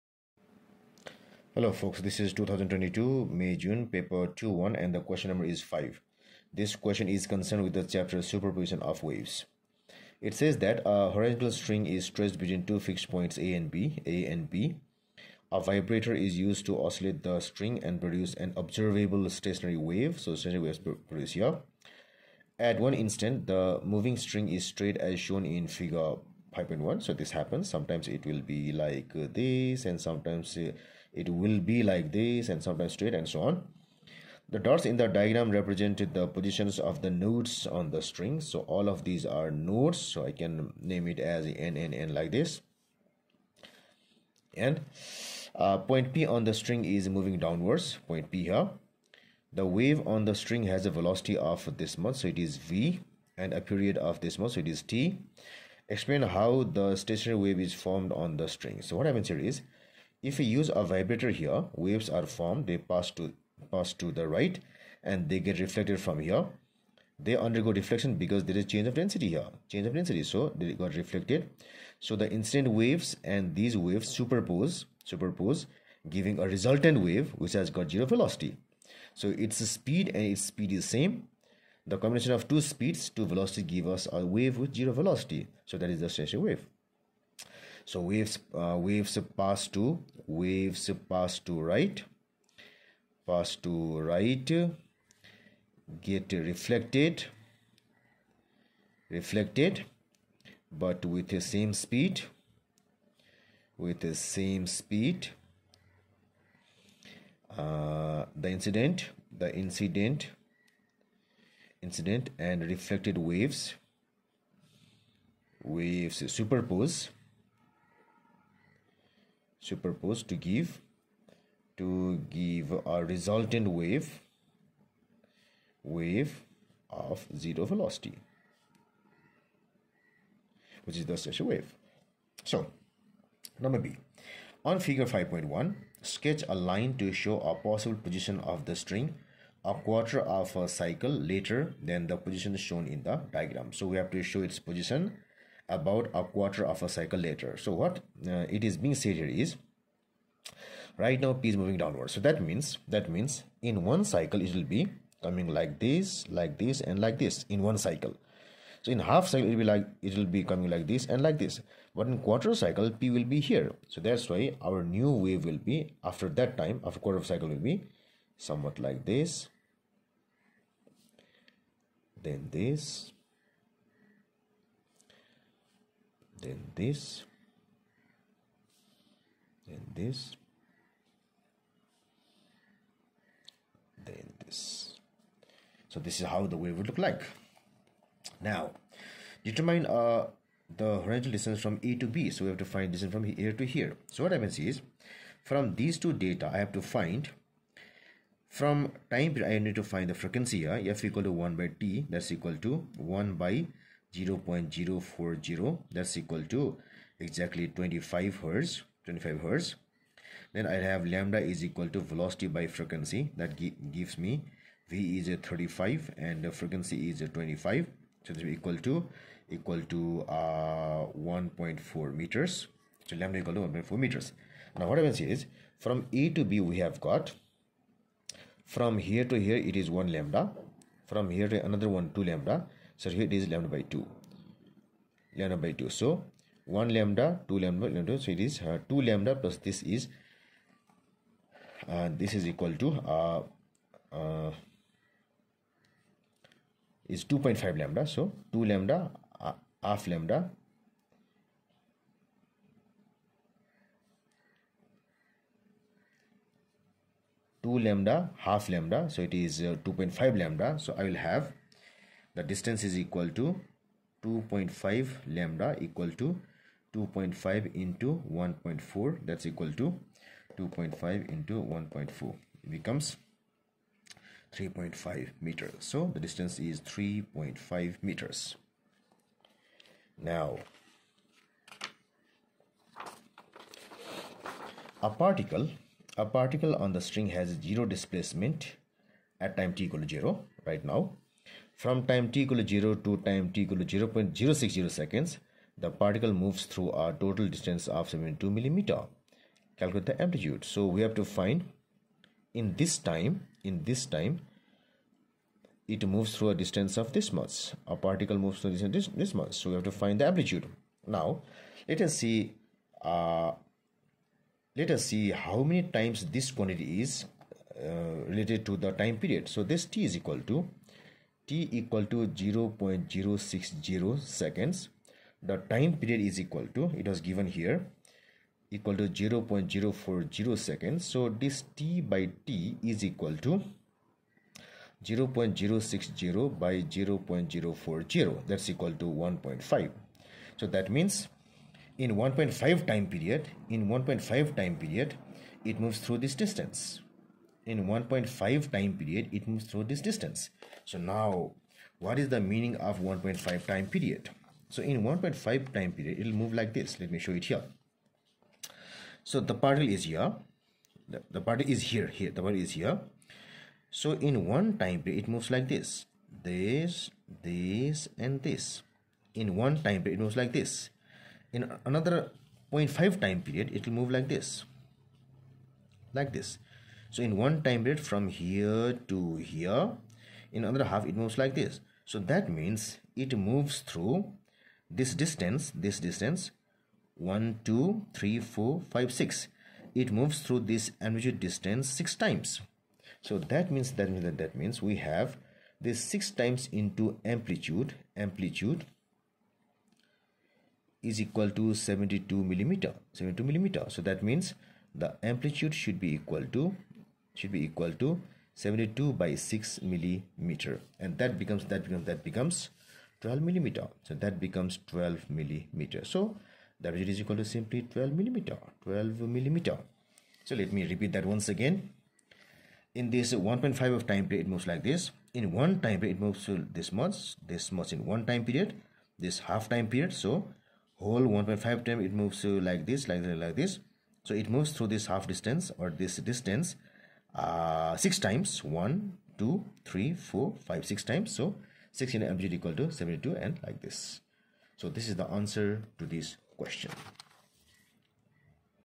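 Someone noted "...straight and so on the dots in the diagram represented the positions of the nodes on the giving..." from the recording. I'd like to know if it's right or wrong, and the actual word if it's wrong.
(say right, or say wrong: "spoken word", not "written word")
wrong: "string", not "giving".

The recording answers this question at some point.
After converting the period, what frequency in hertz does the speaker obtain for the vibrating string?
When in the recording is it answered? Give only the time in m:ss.
3:27.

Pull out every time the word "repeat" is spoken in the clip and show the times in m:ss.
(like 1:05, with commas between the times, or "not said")
7:00.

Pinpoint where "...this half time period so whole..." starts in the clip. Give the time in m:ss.
7:09.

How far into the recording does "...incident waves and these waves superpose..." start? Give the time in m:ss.
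1:12.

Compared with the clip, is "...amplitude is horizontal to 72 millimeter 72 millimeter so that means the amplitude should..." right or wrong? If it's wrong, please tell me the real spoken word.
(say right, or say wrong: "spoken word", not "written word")
wrong: "equal", not "horizontal".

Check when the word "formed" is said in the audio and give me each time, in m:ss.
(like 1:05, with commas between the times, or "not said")
0:57, 1:02.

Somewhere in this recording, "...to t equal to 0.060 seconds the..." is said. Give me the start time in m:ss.
5:20.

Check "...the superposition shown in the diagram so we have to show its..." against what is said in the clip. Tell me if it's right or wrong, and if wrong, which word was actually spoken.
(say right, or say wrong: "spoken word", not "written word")
wrong: "position", not "superposition".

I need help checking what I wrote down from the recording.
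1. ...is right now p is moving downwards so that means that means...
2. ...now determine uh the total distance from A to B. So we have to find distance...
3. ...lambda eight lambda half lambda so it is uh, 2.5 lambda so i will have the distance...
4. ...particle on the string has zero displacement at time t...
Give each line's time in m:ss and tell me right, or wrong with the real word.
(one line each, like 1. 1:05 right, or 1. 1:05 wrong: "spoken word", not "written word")
1. 2:29 right
2. 3:08 wrong: "horizontal", not "total"
3. 4:10 wrong: "two", not "eight"
4. 4:46 right.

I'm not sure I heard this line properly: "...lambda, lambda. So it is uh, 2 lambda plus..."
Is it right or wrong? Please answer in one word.
right.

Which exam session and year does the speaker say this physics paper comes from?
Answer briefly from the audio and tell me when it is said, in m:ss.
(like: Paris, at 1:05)
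2022 May-June, at 0:02.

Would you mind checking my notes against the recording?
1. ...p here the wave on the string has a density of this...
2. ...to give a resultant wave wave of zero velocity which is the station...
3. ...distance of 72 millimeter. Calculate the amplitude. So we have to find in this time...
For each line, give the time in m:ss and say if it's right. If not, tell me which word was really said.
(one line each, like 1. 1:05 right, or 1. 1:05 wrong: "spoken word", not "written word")
1. 0:48 wrong: "velocity", not "density"
2. 2:01 right
3. 4:57 right.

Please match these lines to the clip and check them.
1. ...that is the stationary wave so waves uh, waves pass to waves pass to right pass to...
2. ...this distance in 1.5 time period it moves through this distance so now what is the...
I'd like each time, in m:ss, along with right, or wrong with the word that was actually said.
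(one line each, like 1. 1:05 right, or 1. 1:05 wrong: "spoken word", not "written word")
1. 1:25 right
2. 5:46 right.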